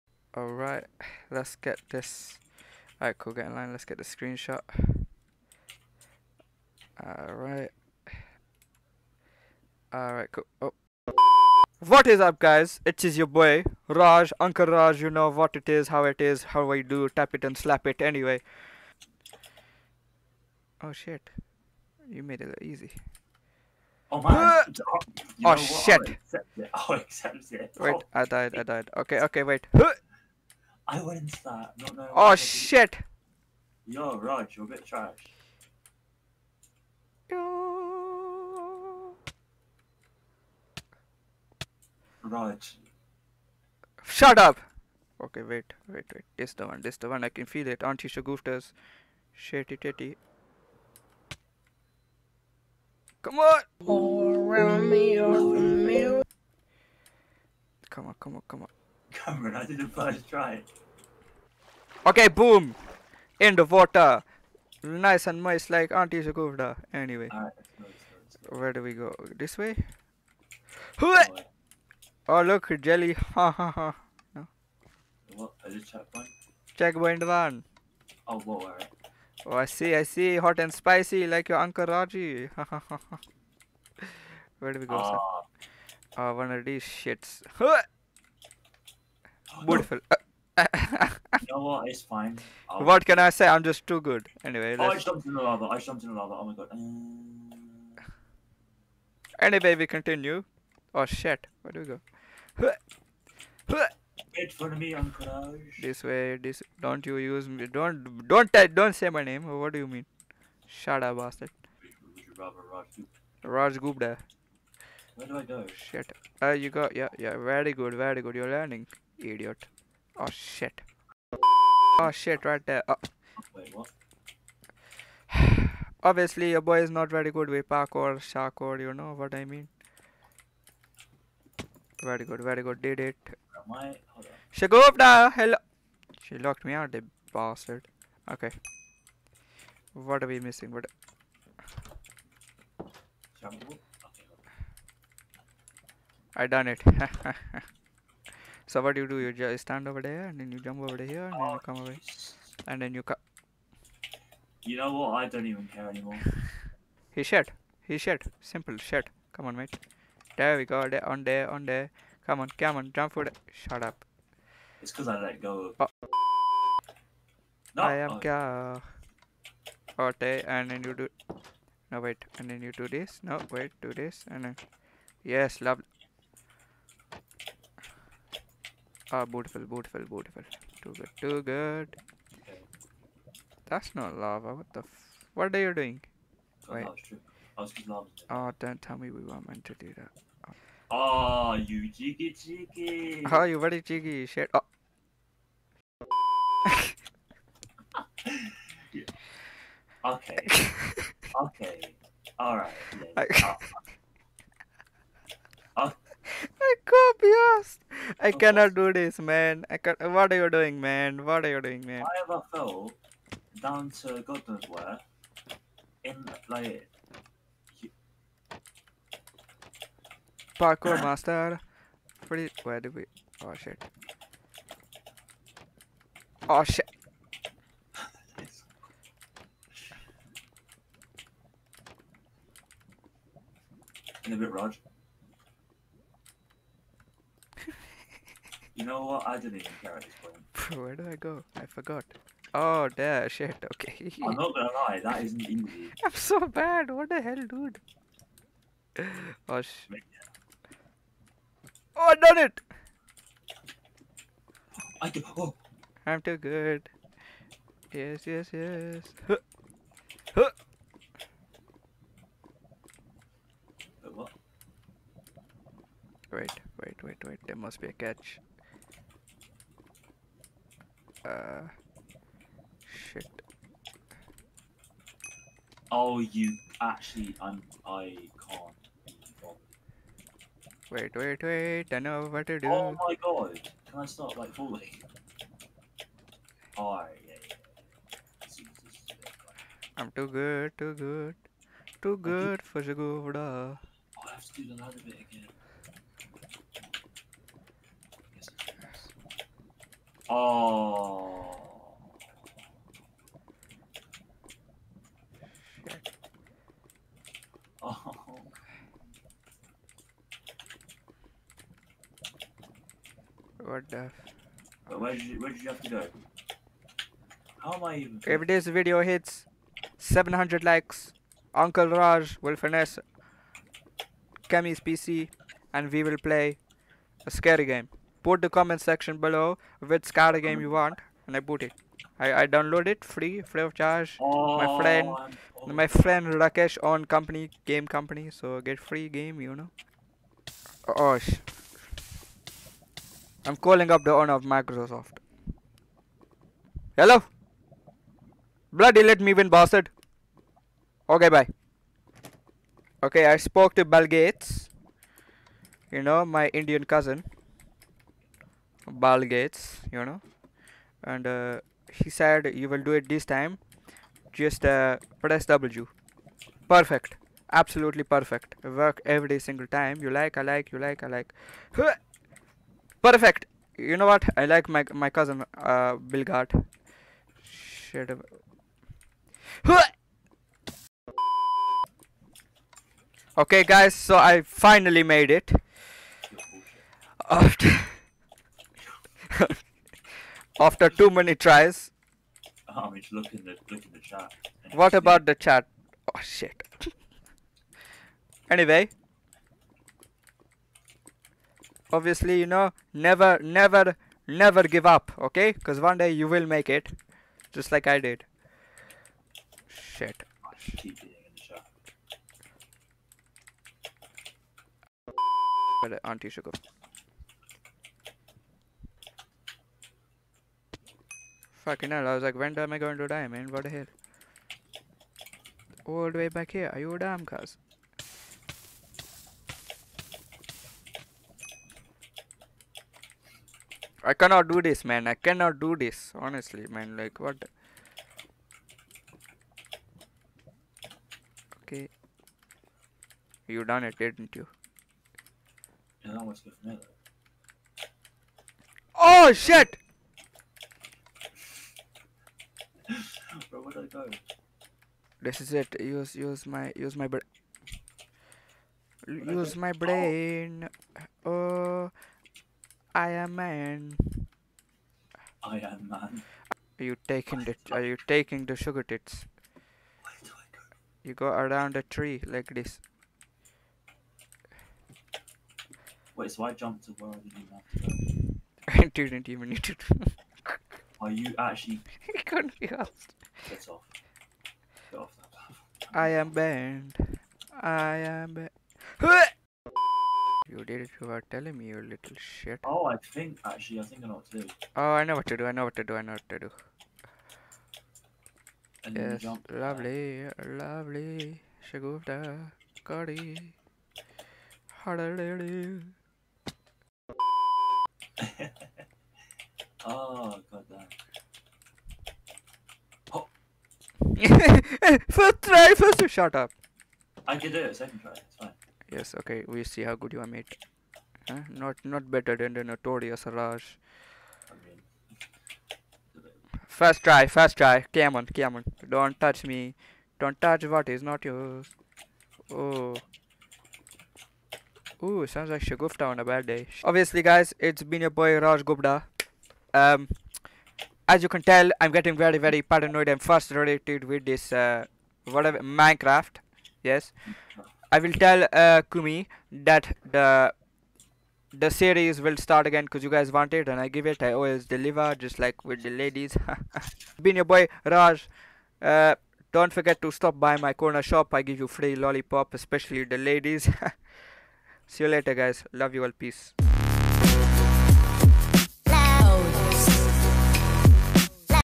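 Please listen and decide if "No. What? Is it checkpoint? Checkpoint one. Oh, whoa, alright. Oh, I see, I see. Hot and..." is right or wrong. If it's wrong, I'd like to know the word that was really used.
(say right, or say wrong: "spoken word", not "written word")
right.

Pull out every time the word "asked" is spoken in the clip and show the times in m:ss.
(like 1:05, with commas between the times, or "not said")
3:27, 8:02.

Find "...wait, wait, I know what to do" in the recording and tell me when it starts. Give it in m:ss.
4:41.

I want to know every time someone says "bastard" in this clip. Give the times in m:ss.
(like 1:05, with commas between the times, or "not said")
1:51, 2:17, 5:49.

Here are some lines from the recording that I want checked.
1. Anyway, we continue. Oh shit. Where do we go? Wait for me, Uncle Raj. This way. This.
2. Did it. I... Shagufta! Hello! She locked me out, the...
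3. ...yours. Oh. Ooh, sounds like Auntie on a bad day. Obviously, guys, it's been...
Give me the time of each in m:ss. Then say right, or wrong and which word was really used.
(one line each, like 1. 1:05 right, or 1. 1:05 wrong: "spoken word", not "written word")
1. 1:39 right
2. 2:12 right
3. 8:51 wrong: "Shagufta", not "Auntie".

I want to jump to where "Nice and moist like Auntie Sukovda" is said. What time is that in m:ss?
1:04.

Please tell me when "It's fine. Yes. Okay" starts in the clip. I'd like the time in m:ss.
8:38.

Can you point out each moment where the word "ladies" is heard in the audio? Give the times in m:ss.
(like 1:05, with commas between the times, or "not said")
9:16, 9:23.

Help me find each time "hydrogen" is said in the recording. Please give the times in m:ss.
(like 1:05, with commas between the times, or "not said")
not said.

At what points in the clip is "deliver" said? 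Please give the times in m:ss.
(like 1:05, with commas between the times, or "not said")
9:14.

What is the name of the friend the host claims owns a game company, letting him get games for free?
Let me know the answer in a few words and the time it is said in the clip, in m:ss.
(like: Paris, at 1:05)
Rakesh, at 5:36.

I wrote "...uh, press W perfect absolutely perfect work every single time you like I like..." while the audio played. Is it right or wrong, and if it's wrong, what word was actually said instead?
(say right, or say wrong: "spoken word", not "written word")
right.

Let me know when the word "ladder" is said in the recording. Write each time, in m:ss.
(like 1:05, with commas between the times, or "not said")
4:54.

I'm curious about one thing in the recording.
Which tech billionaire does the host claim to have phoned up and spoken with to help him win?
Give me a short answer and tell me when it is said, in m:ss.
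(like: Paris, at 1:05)
Bill Gates, at 5:53.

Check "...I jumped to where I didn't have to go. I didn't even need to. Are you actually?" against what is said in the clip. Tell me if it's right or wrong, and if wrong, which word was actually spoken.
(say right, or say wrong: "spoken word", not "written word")
right.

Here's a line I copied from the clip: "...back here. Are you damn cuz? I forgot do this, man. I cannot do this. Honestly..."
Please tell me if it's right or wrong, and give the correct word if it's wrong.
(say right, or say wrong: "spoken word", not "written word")
wrong: "cannot", not "forgot".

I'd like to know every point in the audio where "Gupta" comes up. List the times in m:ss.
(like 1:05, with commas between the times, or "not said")
1:53, 8:58.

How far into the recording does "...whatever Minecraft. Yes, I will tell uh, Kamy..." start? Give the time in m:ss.
9:05.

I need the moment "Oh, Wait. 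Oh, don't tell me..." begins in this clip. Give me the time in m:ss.
3:06.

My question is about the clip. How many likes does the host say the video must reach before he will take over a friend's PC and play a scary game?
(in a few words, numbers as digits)
700.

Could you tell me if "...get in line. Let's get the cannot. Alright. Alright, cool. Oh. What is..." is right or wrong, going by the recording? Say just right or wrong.
wrong.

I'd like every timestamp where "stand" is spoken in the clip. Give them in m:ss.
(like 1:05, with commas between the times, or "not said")
2:29.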